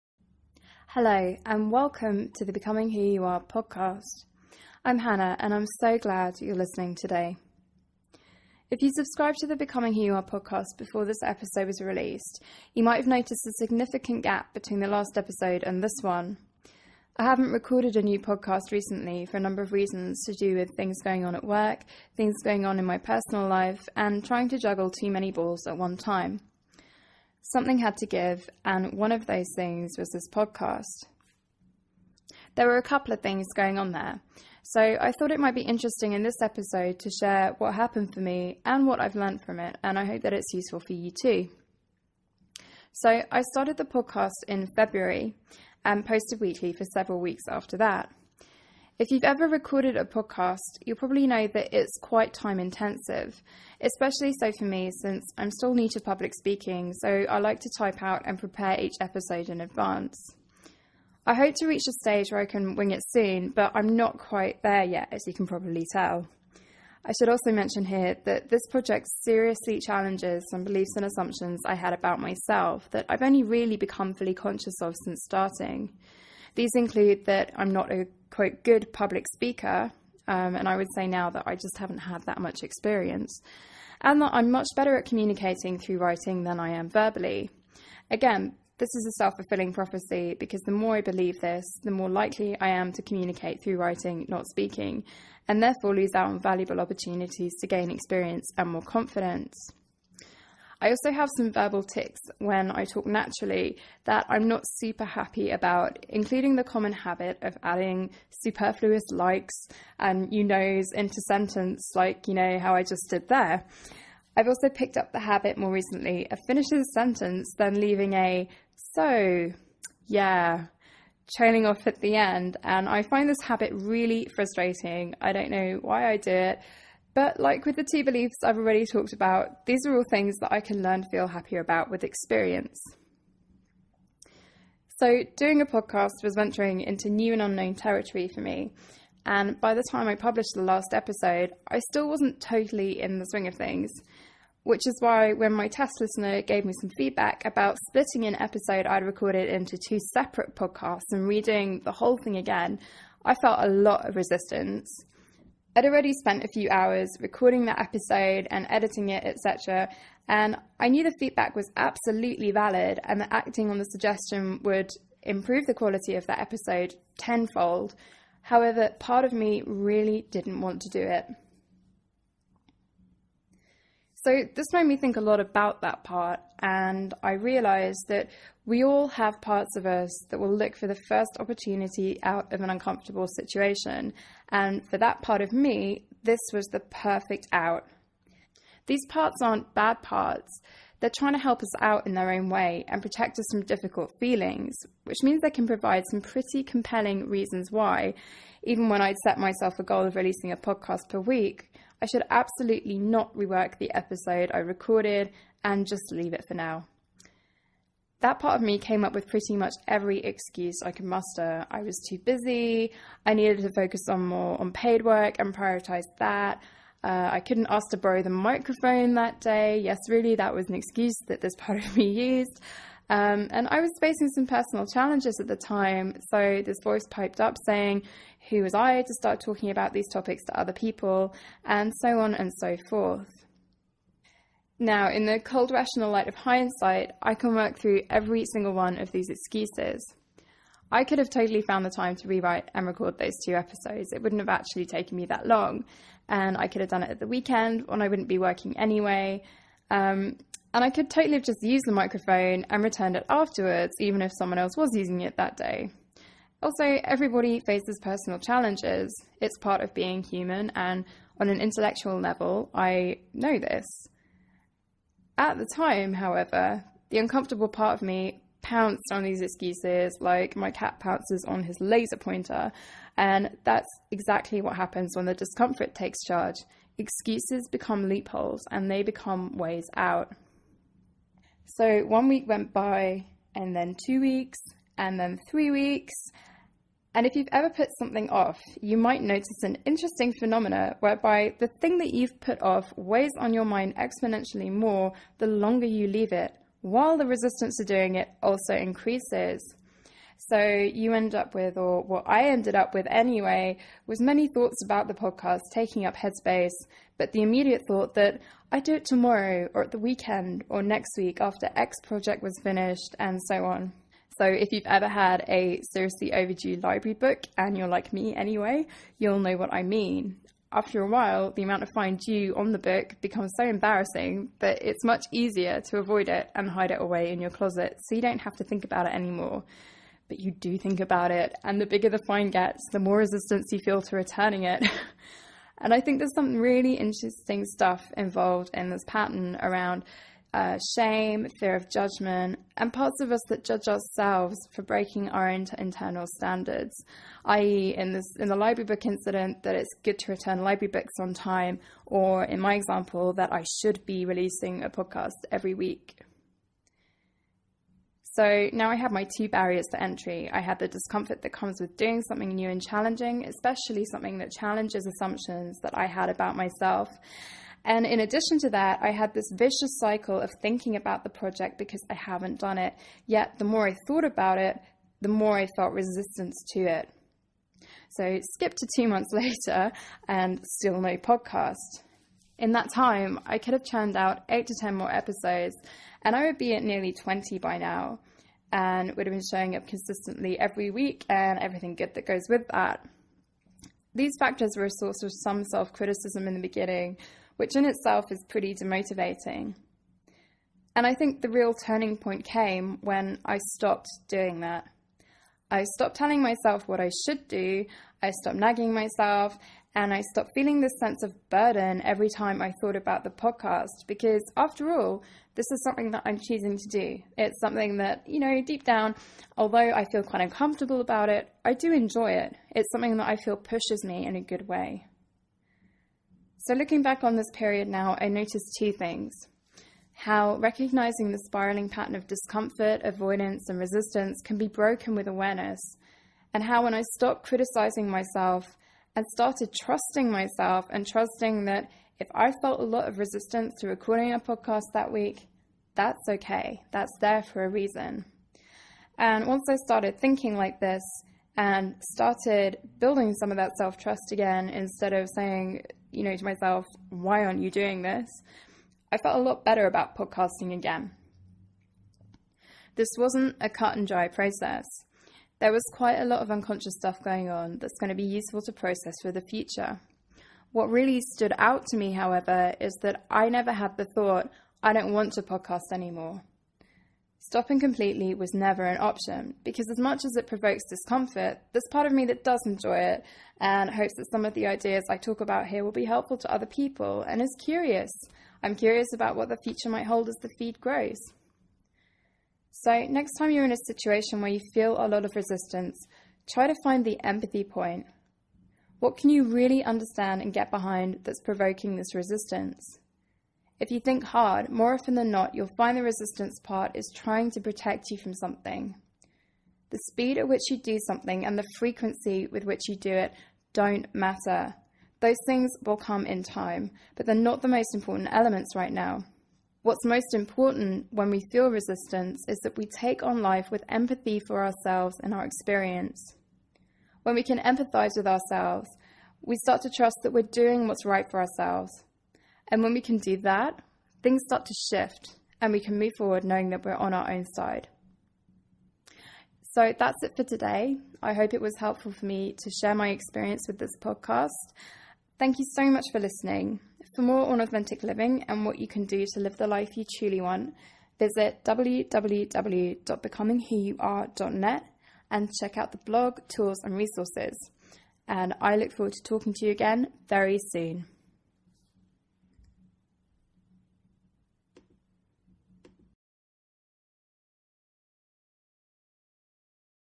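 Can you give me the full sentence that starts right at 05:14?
So if you've ever had a seriously overdue library book and you're like me anyway, you'll know what I mean.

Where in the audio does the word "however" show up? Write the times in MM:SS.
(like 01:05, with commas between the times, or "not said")
02:48, 04:26, 07:52.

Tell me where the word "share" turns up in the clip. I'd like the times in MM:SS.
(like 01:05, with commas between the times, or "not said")
00:37, 09:02.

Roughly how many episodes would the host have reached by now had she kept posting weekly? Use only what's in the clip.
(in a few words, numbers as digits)
nearly 20.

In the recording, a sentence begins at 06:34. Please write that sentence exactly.
These factors were a source of some self criticism in the beginning, which in itself is pretty demotivating.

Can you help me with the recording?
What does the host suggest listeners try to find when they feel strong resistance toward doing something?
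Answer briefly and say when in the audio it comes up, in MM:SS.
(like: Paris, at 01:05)
the empathy point, at 08:17.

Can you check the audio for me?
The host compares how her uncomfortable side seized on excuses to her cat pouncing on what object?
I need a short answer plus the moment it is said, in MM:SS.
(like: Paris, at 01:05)
laser pointer, at 04:31.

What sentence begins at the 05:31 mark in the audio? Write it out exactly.
And the bigger the fine gets, the more resistance you feel to returning it.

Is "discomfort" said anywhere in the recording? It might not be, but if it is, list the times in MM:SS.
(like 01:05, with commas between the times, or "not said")
04:35, 06:00, 07:12, 08:00.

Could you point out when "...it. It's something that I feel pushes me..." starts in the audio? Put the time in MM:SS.
07:02.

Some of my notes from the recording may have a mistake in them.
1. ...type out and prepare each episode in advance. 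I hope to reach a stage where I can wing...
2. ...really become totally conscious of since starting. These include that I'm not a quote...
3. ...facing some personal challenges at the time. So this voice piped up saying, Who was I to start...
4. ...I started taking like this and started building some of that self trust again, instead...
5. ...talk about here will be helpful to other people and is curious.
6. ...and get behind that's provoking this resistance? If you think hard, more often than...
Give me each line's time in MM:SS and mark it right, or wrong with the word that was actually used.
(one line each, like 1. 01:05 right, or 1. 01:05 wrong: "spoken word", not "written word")
1. 00:57 right
2. 01:13 wrong: "fully", not "totally"
3. 03:43 right
4. 07:29 wrong: "thinking", not "taking"
5. 08:05 right
6. 08:20 right.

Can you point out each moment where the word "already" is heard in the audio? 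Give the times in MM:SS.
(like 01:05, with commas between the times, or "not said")
02:08, 02:35.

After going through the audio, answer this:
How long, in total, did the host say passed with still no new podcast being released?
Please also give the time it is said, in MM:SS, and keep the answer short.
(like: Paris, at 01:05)
2 months, at 06:18.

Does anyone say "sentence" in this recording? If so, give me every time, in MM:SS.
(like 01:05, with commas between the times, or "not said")
01:51, 01:56.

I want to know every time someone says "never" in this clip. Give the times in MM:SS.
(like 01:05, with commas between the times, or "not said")
07:53, 07:58.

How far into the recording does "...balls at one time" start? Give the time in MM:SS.
00:25.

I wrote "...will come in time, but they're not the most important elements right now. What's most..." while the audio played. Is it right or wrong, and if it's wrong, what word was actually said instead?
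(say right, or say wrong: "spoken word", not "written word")
right.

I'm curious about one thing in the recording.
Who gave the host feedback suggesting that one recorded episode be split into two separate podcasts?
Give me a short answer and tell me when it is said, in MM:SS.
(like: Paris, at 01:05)
test listener, at 02:25.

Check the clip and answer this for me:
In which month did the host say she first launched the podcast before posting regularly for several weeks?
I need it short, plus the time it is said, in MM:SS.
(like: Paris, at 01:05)
February, at 00:44.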